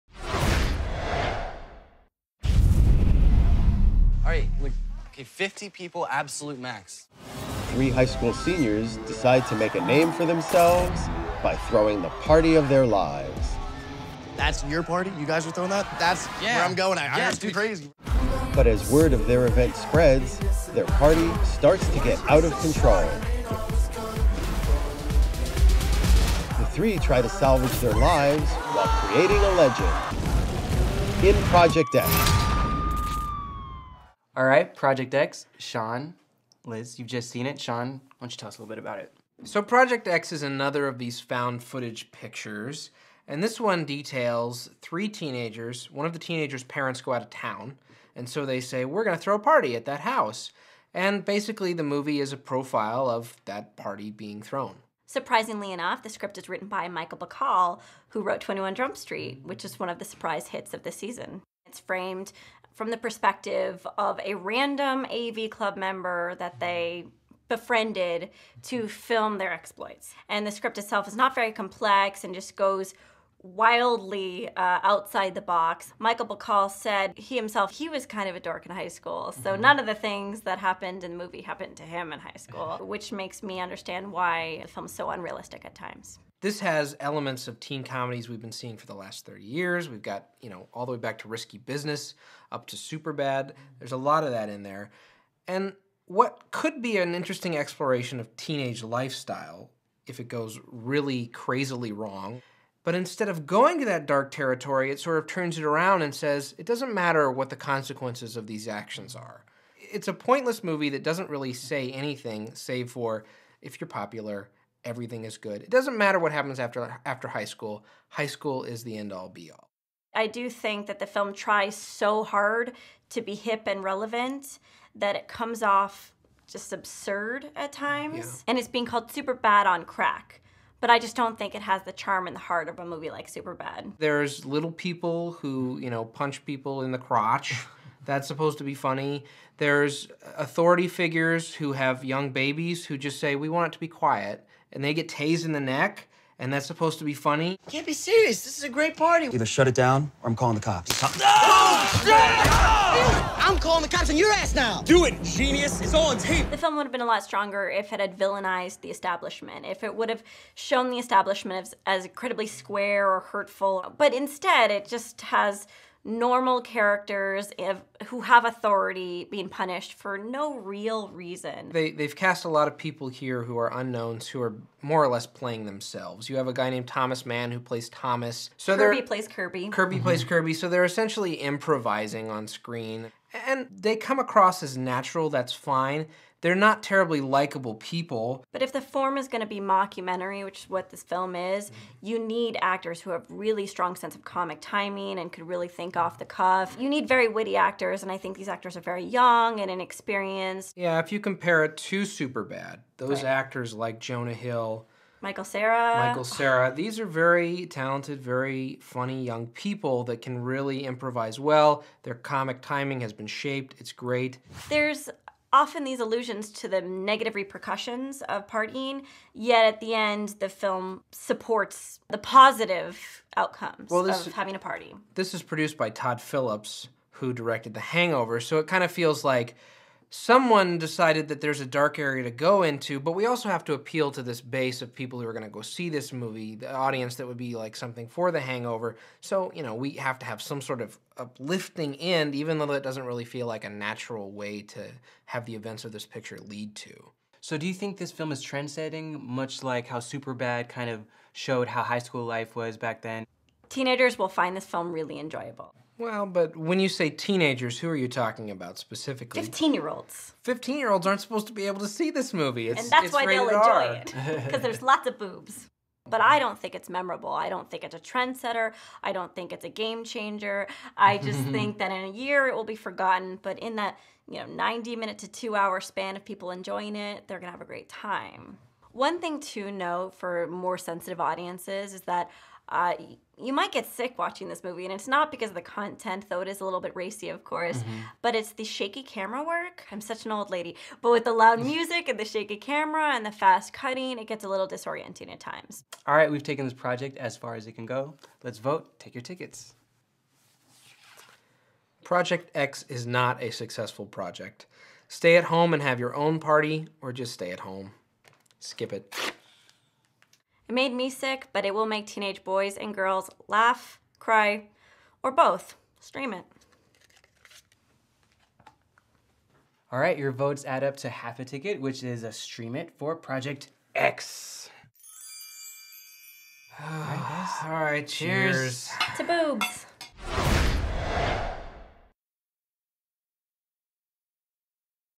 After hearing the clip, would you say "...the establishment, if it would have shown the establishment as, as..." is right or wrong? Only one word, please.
right.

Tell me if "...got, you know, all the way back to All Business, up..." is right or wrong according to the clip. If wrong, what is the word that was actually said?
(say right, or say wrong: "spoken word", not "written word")
wrong: "Risky", not "All".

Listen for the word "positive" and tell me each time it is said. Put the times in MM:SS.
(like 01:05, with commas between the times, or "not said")
03:42.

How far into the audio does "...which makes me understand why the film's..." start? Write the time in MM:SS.
01:22.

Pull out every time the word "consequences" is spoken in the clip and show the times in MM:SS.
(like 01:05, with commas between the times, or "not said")
01:47.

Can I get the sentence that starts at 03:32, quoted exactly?
Their comic timing has been shaped.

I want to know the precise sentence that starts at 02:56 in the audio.
You have a guy named Thomas Mann who plays Thomas.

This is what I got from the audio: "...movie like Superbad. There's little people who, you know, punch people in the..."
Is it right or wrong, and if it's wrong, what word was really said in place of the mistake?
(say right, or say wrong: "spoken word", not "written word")
right.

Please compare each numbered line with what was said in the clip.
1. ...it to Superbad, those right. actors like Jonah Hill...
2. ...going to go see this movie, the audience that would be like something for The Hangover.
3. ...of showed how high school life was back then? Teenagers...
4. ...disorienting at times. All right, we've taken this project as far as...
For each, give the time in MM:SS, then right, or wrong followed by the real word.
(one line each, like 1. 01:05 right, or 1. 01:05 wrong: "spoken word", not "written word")
1. 03:21 right
2. 03:55 right
3. 04:10 right
4. 04:54 right.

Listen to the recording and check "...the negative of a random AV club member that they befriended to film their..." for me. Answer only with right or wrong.
wrong.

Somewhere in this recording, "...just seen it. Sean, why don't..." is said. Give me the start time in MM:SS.
00:37.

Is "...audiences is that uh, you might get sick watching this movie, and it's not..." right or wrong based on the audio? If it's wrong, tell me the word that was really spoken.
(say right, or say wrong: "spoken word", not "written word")
right.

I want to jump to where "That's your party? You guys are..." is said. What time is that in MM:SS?
00:14.